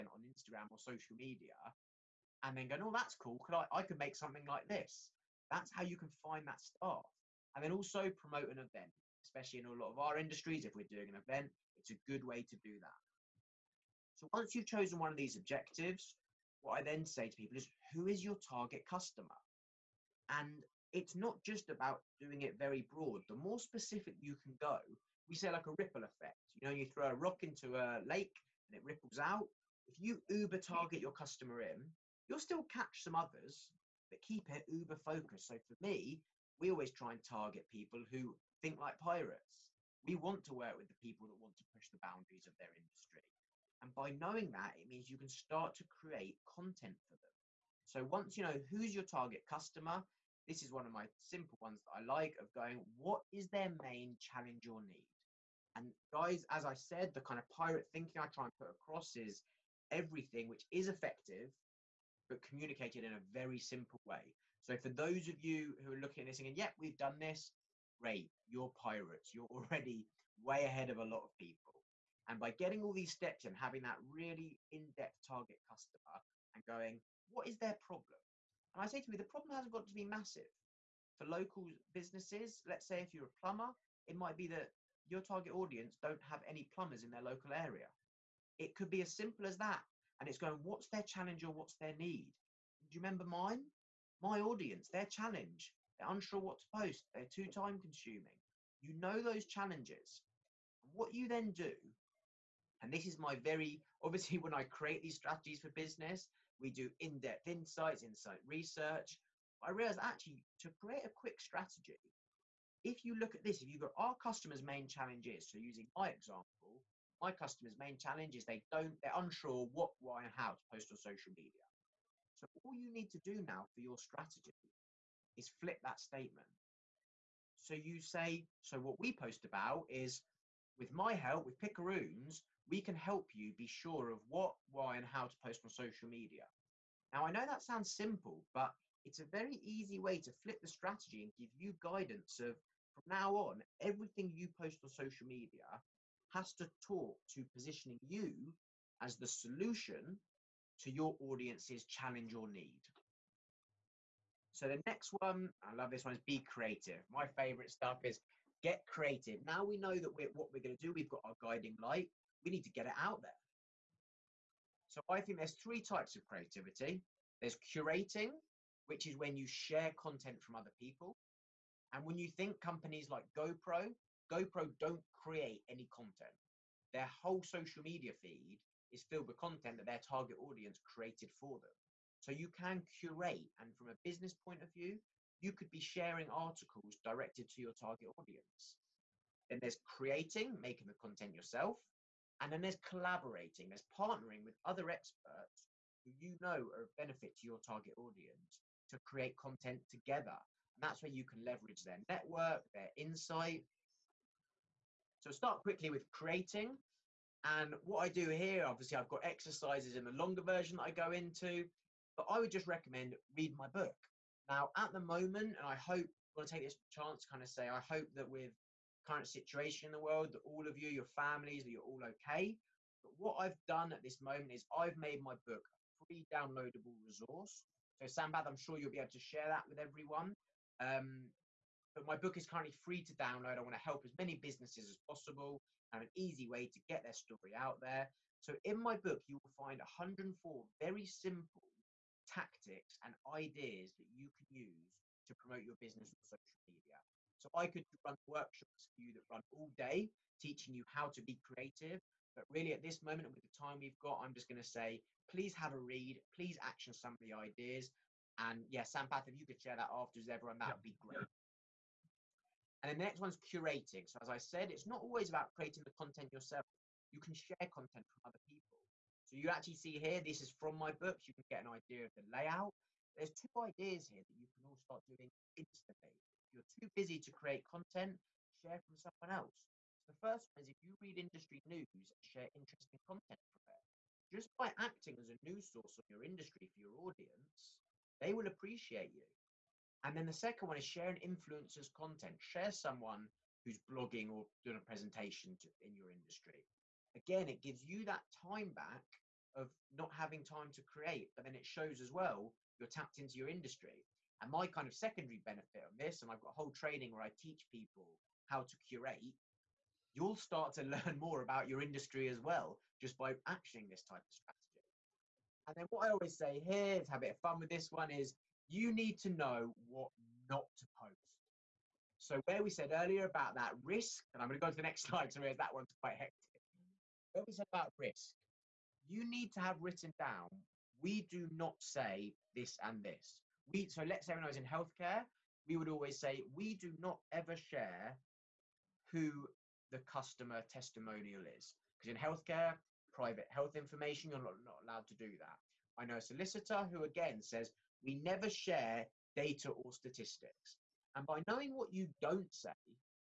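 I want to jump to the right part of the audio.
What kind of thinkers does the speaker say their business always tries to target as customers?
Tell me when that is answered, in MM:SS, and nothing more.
00:37.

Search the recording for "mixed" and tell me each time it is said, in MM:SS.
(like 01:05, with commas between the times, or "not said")
not said.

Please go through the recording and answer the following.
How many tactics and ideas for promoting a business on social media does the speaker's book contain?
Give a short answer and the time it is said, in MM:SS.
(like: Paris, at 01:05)
104, at 03:59.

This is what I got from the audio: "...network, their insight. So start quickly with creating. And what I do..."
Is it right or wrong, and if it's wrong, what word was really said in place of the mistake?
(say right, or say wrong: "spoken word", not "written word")
right.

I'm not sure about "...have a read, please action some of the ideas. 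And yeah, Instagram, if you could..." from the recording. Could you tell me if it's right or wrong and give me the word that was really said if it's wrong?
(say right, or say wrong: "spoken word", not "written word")
wrong: "Sampath", not "Instagram".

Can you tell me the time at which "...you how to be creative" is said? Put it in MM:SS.
04:10.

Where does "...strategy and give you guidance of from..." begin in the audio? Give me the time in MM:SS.
02:20.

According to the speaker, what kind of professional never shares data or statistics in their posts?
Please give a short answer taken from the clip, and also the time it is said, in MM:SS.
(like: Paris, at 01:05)
A solicitor, at 05:46.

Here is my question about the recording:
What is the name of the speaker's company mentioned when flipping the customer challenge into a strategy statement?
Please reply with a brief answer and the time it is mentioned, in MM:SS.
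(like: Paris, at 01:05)
Picaroons, at 02:11.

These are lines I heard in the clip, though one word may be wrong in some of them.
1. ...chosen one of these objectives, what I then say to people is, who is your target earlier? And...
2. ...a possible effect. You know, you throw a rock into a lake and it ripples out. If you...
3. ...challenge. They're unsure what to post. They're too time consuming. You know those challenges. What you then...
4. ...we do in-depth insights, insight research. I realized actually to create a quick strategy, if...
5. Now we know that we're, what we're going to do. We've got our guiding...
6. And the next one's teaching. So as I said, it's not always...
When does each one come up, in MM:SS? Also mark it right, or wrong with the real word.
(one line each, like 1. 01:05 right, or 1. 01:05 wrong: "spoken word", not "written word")
1. 00:14 wrong: "customer", not "earlier"
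2. 00:25 wrong: "ripple", not "possible"
3. 01:35 right
4. 01:46 right
5. 02:39 right
6. 04:22 wrong: "curating", not "teaching".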